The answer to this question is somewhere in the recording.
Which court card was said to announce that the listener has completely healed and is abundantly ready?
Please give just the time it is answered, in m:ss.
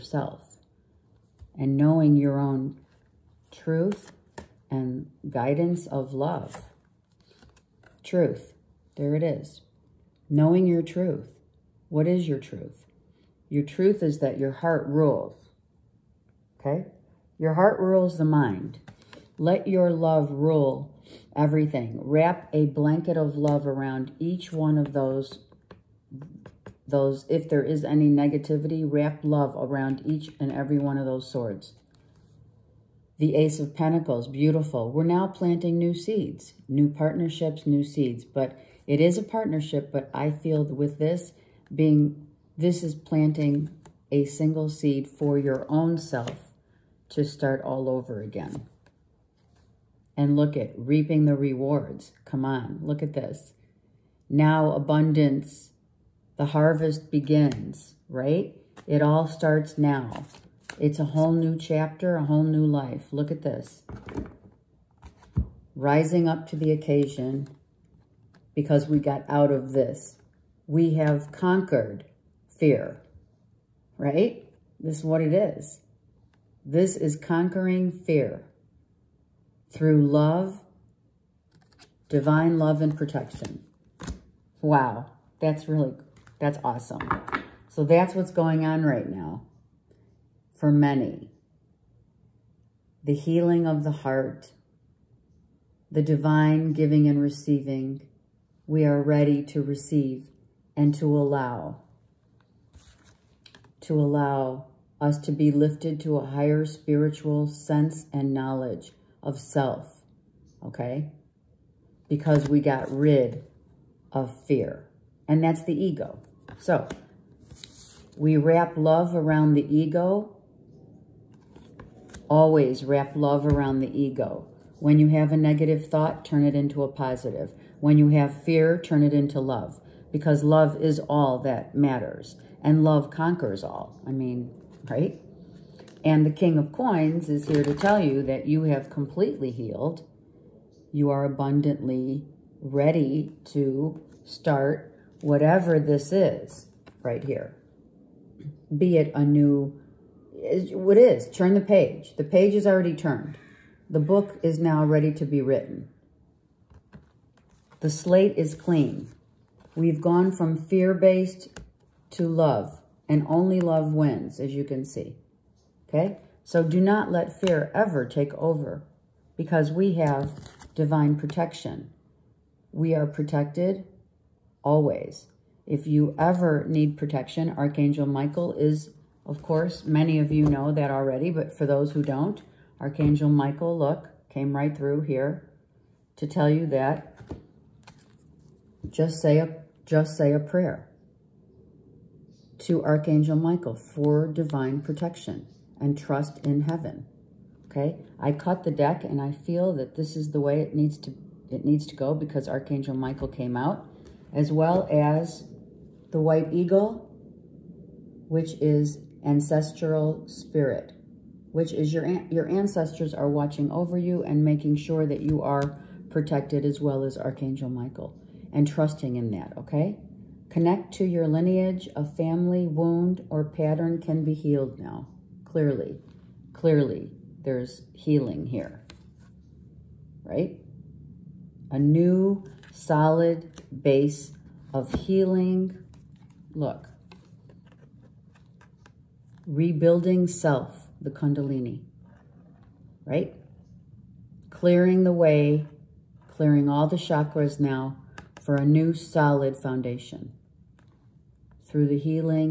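2:16.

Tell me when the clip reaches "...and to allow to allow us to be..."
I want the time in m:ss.
1:40.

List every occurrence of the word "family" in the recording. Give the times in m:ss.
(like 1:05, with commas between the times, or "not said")
3:42.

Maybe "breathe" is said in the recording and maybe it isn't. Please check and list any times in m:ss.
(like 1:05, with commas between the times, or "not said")
not said.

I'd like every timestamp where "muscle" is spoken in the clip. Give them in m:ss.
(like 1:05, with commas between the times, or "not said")
not said.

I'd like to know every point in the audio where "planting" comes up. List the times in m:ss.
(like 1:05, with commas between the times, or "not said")
0:35, 0:42.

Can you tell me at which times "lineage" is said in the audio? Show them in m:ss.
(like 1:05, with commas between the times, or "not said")
3:41.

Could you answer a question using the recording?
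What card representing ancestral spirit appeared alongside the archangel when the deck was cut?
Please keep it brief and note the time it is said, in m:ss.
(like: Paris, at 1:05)
White Eagle, at 3:26.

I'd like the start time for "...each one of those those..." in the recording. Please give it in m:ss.
0:24.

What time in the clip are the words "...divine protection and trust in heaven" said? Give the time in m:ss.
3:14.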